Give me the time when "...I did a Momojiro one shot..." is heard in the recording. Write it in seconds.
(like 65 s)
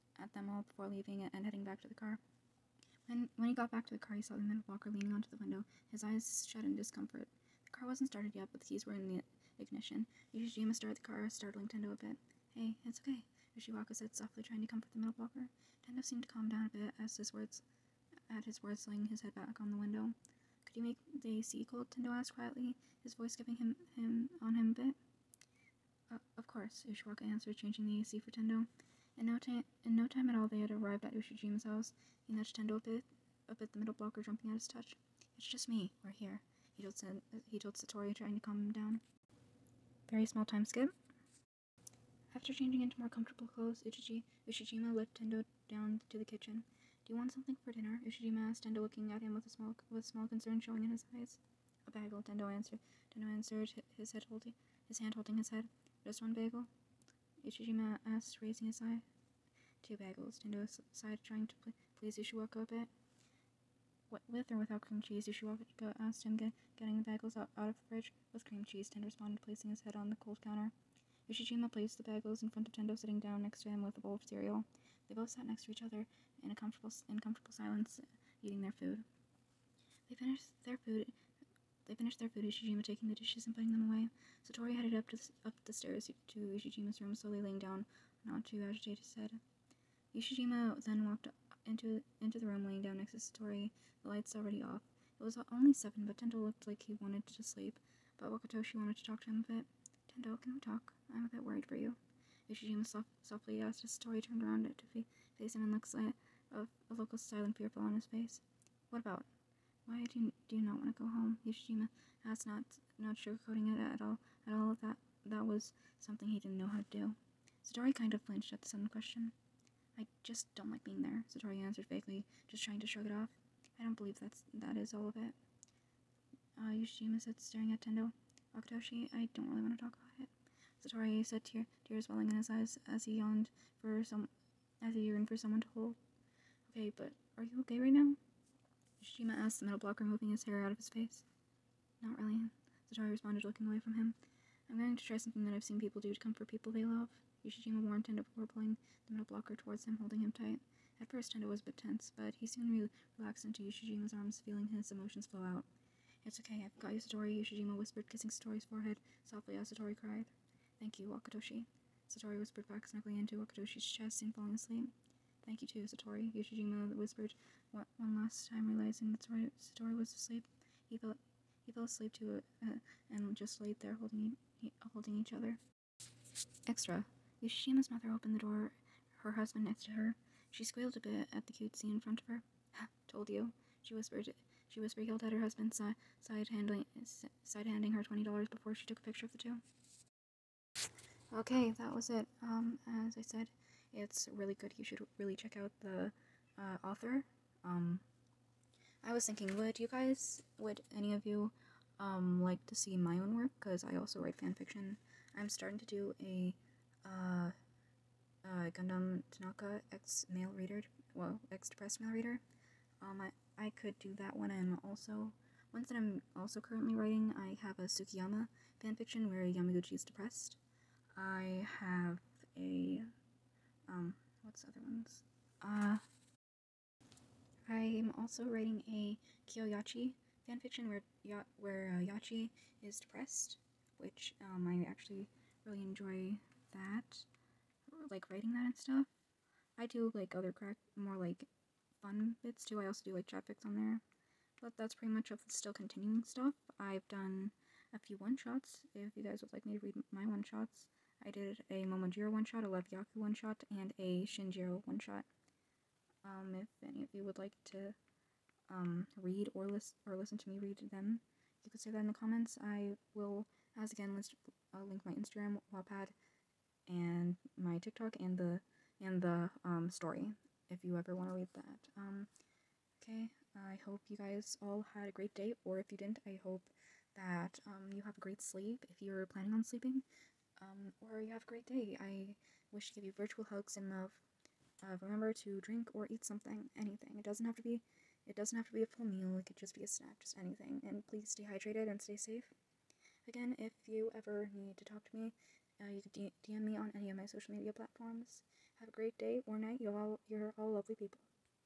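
251 s.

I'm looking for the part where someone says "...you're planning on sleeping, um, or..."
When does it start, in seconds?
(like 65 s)
279 s.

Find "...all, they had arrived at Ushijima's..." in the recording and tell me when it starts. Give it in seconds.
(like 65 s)
30 s.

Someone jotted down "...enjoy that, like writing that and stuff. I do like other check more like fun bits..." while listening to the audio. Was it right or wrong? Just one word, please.
wrong.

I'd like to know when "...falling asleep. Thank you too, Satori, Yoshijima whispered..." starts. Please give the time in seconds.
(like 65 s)
164 s.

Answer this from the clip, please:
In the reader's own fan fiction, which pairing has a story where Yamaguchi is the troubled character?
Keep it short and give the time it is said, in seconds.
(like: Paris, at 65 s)
Tsukkiyama, at 217 s.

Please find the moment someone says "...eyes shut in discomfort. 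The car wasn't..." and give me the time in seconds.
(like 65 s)
6 s.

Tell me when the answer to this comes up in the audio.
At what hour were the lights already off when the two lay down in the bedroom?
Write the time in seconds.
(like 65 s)
95 s.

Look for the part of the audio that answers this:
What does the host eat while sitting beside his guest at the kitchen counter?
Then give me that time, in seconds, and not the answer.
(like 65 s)
73 s.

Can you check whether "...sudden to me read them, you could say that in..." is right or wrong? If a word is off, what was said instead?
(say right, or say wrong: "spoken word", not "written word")
wrong: "listen", not "sudden".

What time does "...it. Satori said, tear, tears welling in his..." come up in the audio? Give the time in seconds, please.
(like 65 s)
130 s.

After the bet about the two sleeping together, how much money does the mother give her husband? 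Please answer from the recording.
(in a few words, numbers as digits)
$20.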